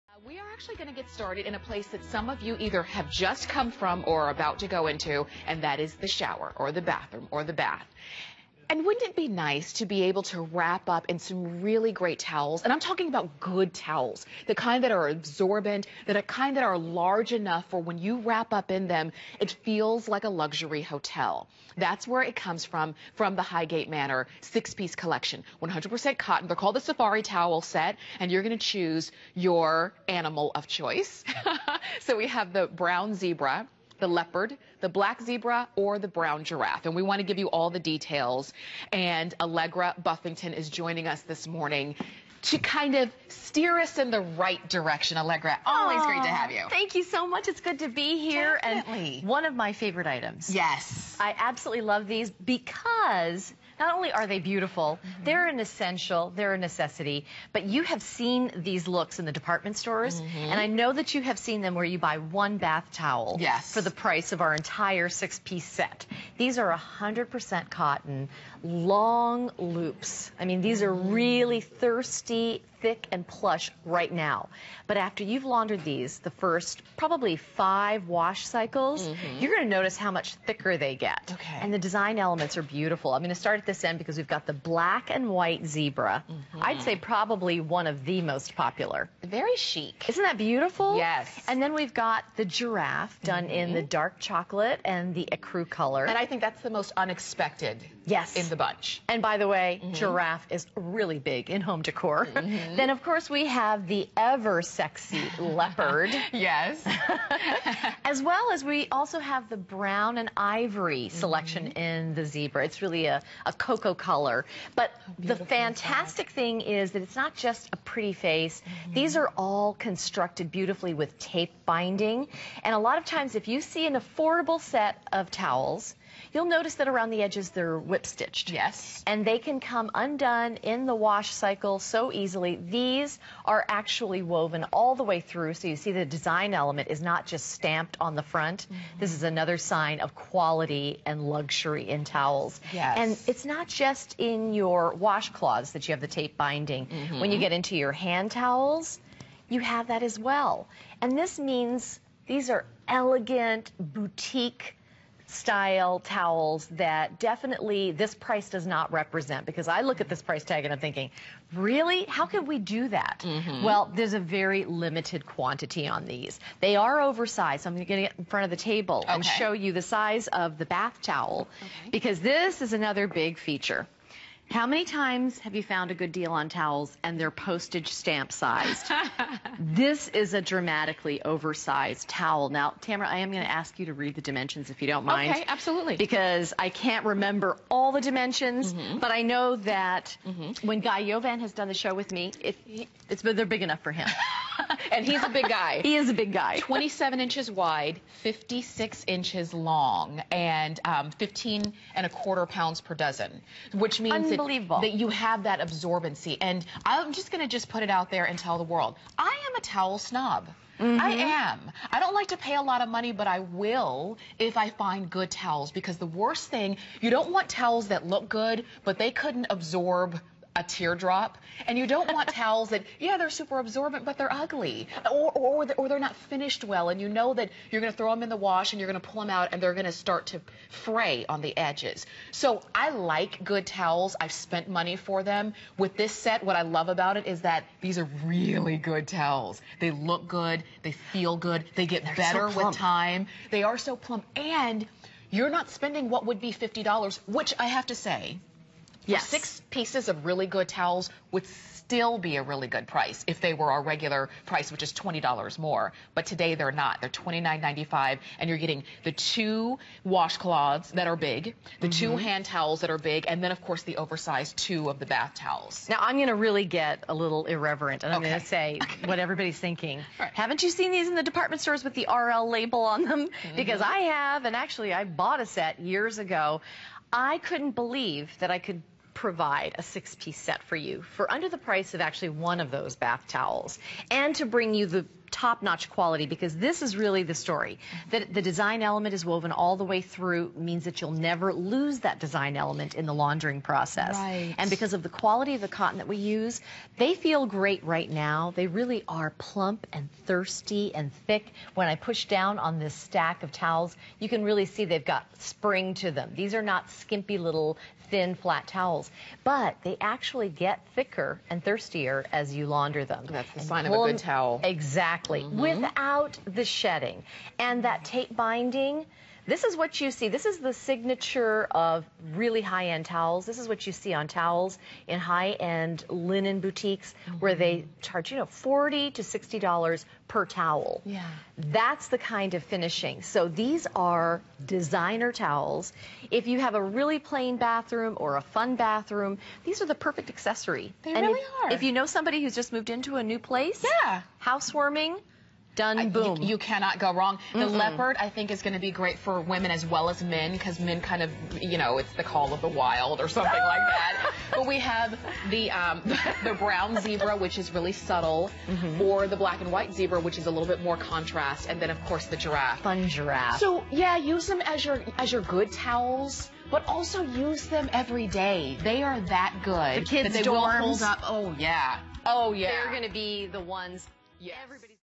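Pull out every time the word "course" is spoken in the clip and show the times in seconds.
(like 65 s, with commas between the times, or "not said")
103 s, 263 s, 362 s.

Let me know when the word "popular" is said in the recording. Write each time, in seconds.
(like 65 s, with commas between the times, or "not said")
88 s.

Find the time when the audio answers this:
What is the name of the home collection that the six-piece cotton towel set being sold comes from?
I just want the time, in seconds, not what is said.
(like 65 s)
23 s.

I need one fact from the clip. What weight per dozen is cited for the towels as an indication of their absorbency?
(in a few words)
15.25 pounds.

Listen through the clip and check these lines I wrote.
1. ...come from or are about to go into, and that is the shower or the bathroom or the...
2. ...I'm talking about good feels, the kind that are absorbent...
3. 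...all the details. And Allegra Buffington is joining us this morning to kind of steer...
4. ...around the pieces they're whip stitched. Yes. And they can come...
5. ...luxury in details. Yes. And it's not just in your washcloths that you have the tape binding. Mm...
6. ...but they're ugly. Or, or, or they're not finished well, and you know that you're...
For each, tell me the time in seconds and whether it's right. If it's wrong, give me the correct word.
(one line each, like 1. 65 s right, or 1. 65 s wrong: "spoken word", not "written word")
1. 3 s right
2. 12 s wrong: "towels", not "feels"
3. 37 s right
4. 126 s wrong: "edges", not "pieces"
5. 141 s wrong: "towels", not "details"
6. 224 s right.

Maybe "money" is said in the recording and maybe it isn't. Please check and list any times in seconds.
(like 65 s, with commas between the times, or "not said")
212 s, 234 s.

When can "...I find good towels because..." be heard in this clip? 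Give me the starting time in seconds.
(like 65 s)
214 s.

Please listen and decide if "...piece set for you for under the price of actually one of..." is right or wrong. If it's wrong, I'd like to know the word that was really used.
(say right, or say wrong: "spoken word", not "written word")
right.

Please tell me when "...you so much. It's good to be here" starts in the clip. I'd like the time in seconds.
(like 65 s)
46 s.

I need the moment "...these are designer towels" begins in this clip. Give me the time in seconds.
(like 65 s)
333 s.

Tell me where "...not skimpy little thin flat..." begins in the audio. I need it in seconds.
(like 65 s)
306 s.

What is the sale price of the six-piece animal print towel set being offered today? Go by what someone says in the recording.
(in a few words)
$29.95.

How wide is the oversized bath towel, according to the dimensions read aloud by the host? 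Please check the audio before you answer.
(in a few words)
27 inches.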